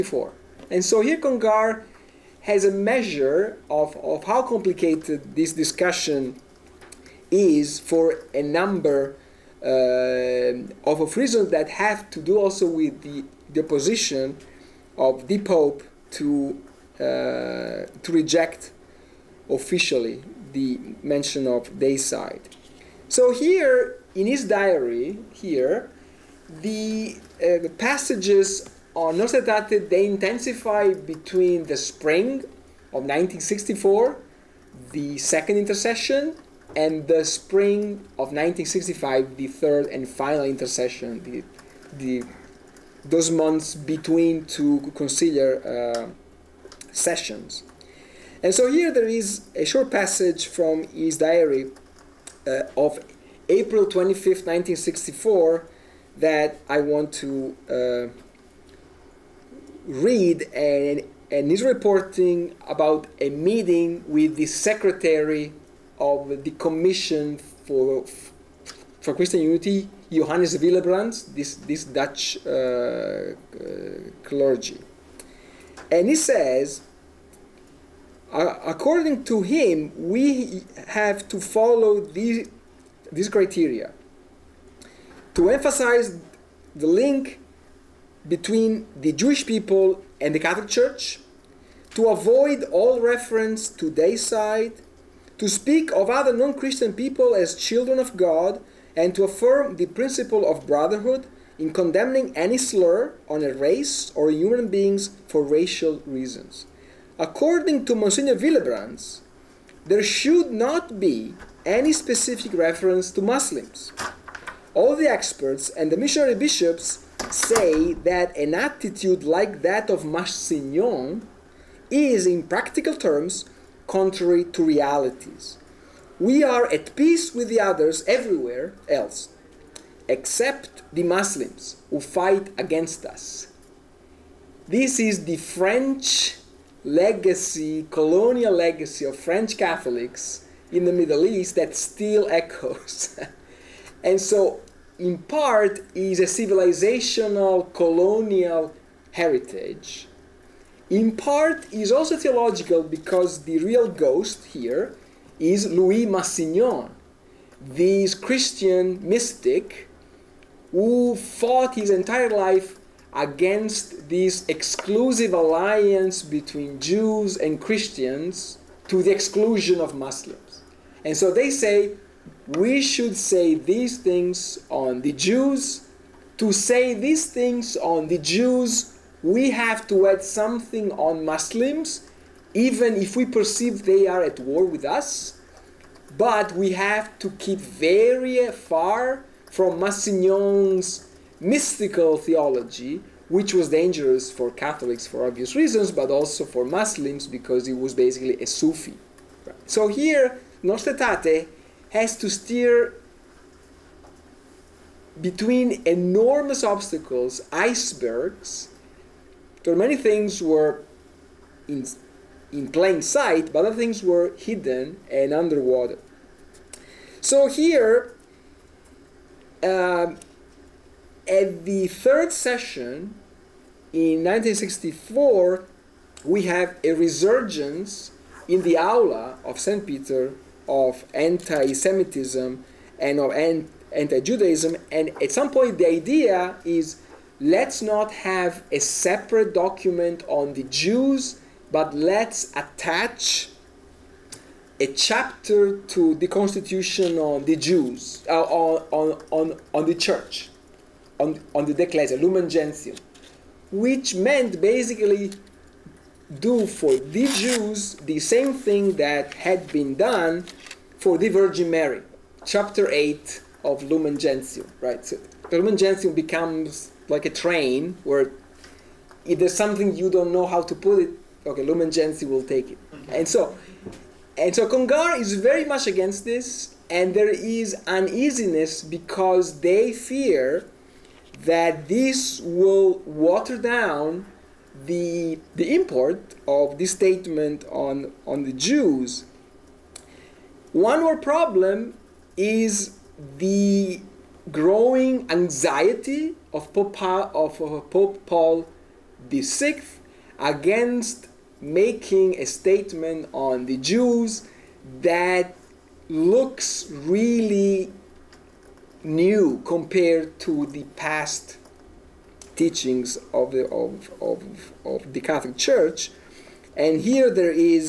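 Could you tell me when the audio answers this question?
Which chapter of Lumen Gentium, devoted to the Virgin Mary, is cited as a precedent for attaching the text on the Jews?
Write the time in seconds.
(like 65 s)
262 s.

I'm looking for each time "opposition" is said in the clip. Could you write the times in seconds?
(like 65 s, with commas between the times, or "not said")
13 s.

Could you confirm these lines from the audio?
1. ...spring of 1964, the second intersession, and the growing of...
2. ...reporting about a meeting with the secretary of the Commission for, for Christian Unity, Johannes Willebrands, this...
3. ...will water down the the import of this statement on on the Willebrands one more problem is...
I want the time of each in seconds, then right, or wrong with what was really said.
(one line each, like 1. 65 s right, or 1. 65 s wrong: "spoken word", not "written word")
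1. 31 s wrong: "spring", not "growing"
2. 61 s right
3. 282 s wrong: "Jews", not "Willebrands".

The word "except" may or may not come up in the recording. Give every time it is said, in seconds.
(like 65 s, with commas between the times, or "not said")
130 s.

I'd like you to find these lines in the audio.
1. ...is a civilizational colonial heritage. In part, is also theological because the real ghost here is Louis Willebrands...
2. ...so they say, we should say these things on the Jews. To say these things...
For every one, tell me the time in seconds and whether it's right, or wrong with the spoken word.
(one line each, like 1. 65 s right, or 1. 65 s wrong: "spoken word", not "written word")
1. 145 s wrong: "Massignon", not "Willebrands"
2. 171 s right.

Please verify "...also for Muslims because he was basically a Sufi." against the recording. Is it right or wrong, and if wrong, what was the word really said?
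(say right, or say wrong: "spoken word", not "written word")
right.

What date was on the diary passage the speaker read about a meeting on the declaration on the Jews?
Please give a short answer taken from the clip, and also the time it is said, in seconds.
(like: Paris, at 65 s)
April 25, 1964, at 53 s.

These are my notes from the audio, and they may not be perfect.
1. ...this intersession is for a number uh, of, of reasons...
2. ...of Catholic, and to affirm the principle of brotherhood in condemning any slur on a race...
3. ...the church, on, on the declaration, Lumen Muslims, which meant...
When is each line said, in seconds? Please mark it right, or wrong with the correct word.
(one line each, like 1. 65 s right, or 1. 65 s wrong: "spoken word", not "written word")
1. 5 s wrong: "discussion", not "intersession"
2. 97 s wrong: "God", not "Catholic"
3. 249 s wrong: "Gentium", not "Muslims".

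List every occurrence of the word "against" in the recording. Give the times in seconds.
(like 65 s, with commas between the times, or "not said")
132 s, 163 s, 275 s, 300 s.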